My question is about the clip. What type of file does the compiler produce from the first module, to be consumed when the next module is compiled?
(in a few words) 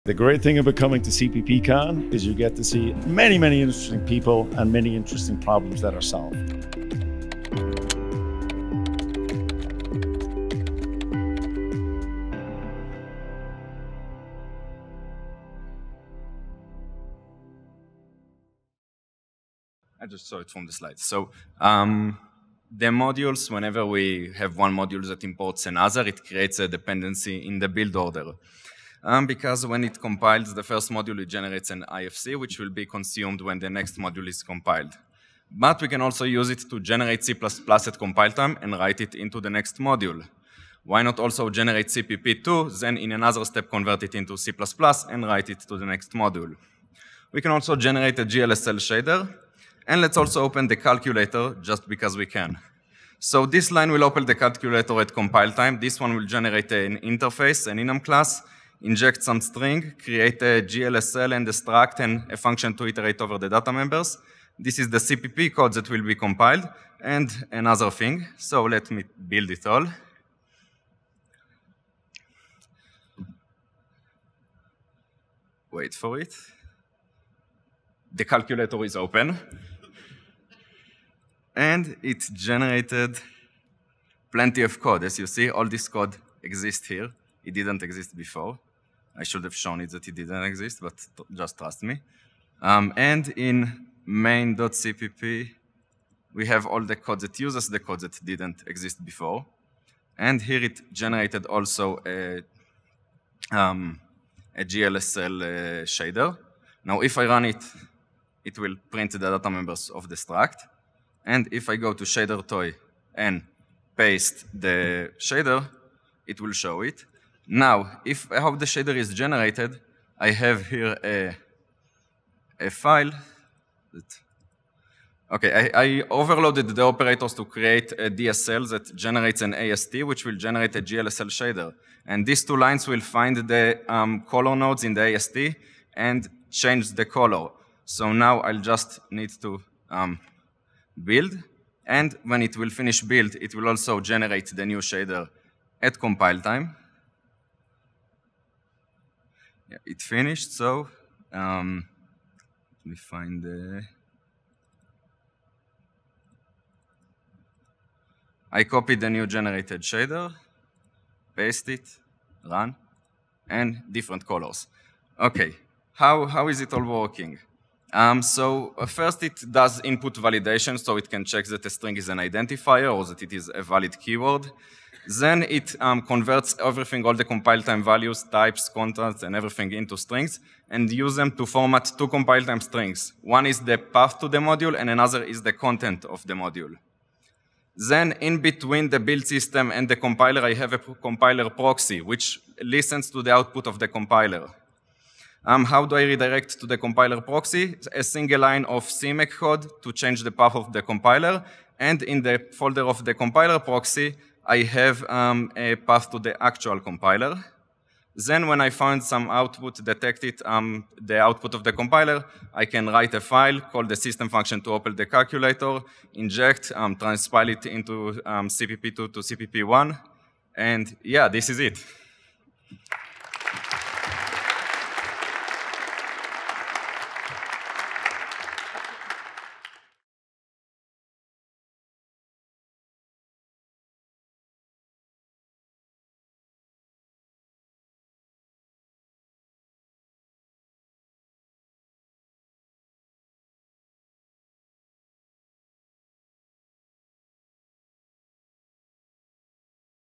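IFC.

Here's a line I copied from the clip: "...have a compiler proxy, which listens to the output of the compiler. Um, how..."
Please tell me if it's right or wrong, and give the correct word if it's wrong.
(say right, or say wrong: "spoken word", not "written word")
right.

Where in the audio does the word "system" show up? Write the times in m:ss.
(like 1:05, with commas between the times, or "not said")
3:09, 3:33.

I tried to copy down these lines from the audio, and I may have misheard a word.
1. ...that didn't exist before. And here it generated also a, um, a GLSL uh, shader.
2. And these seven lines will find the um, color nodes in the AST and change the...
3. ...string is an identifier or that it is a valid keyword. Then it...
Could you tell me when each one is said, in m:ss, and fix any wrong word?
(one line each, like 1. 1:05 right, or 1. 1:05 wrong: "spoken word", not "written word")
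1. 1:38 right
2. 2:12 wrong: "two", not "seven"
3. 2:51 right.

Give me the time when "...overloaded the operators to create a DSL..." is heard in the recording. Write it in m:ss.
2:06.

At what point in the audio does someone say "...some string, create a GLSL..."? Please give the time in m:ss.
0:59.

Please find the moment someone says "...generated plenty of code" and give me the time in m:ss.
1:22.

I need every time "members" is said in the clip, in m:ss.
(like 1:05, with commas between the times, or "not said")
1:03, 1:49.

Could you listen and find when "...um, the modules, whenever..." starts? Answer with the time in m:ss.
0:21.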